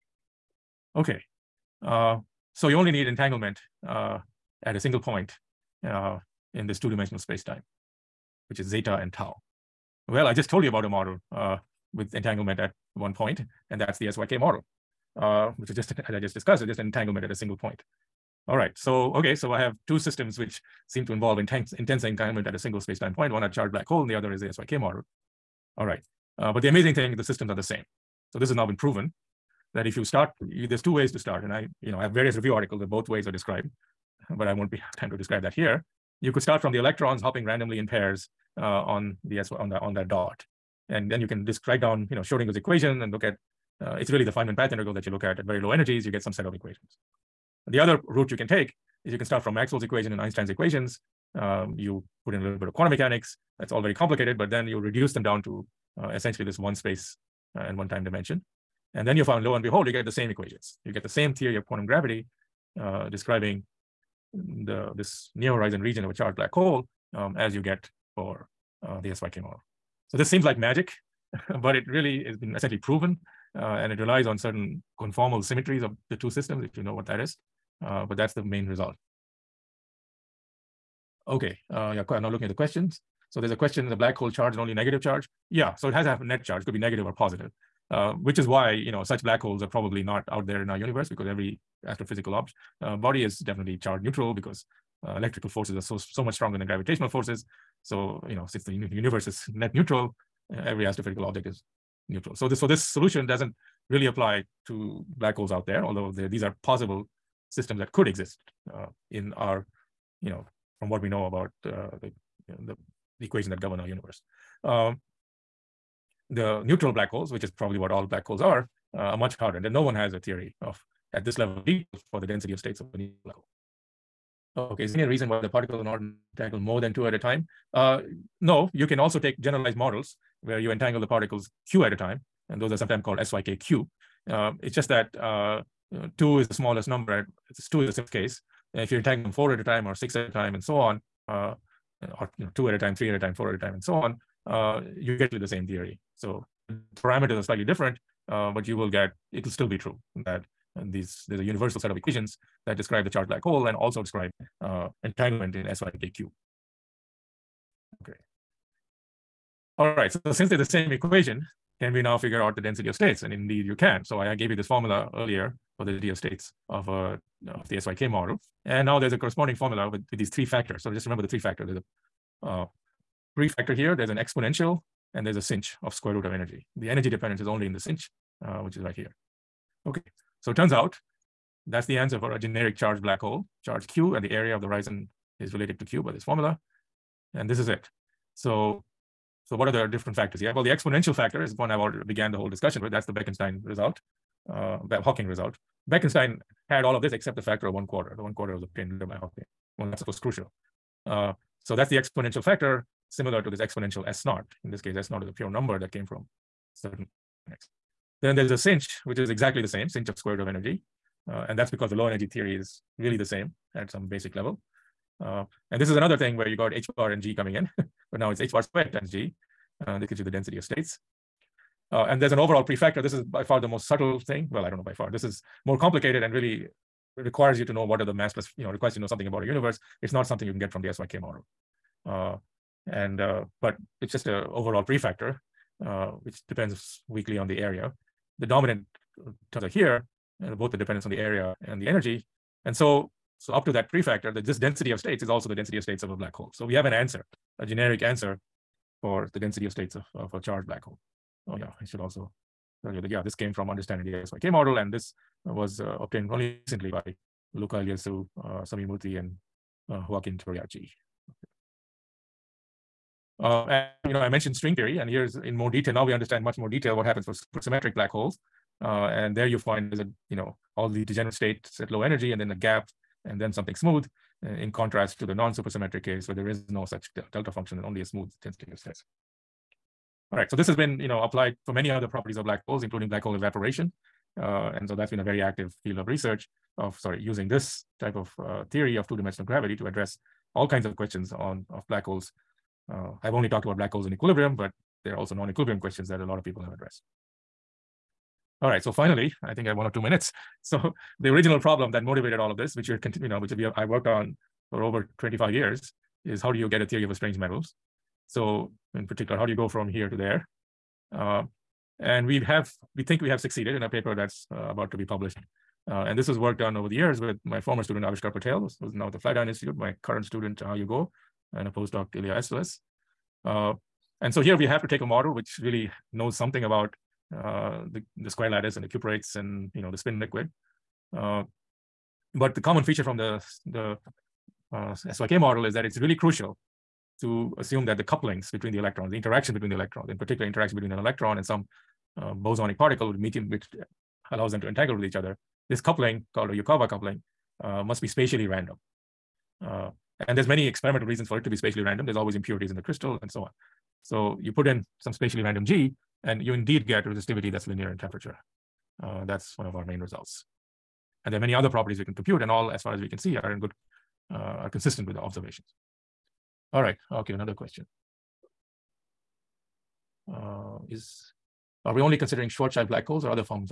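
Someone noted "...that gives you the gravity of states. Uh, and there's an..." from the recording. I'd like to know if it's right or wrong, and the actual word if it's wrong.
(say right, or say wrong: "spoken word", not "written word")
wrong: "density", not "gravity".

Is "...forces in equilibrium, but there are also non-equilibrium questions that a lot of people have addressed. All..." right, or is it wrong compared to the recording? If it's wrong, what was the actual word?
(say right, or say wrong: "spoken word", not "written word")
wrong: "holes", not "forces".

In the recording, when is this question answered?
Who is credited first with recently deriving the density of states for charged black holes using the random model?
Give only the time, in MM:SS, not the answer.
04:17.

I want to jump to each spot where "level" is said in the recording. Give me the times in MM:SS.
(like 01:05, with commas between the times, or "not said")
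02:01, 03:34.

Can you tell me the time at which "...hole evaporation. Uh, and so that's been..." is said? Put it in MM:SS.
04:43.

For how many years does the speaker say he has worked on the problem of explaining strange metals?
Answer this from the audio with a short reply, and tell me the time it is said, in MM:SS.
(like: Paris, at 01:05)
Over 25 years, at 05:04.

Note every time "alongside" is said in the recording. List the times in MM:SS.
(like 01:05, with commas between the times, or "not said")
not said.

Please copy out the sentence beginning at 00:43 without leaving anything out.
Uh, it's really the Feynman path integral that you look at at very low energies.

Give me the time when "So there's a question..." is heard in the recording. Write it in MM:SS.
01:23.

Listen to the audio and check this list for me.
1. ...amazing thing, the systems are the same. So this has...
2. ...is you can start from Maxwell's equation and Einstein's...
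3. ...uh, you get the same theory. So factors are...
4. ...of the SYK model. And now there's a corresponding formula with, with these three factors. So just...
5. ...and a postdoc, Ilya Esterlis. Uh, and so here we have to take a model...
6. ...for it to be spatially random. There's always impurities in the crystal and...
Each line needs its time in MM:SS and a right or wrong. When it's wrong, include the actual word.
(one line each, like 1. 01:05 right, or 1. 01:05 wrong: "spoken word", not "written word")
1. 00:26 right
2. 00:49 right
3. 02:24 wrong: "parameters", not "factors"
4. 02:47 right
5. 05:21 right
6. 05:51 right.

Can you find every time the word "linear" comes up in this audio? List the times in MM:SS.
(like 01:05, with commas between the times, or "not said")
05:57.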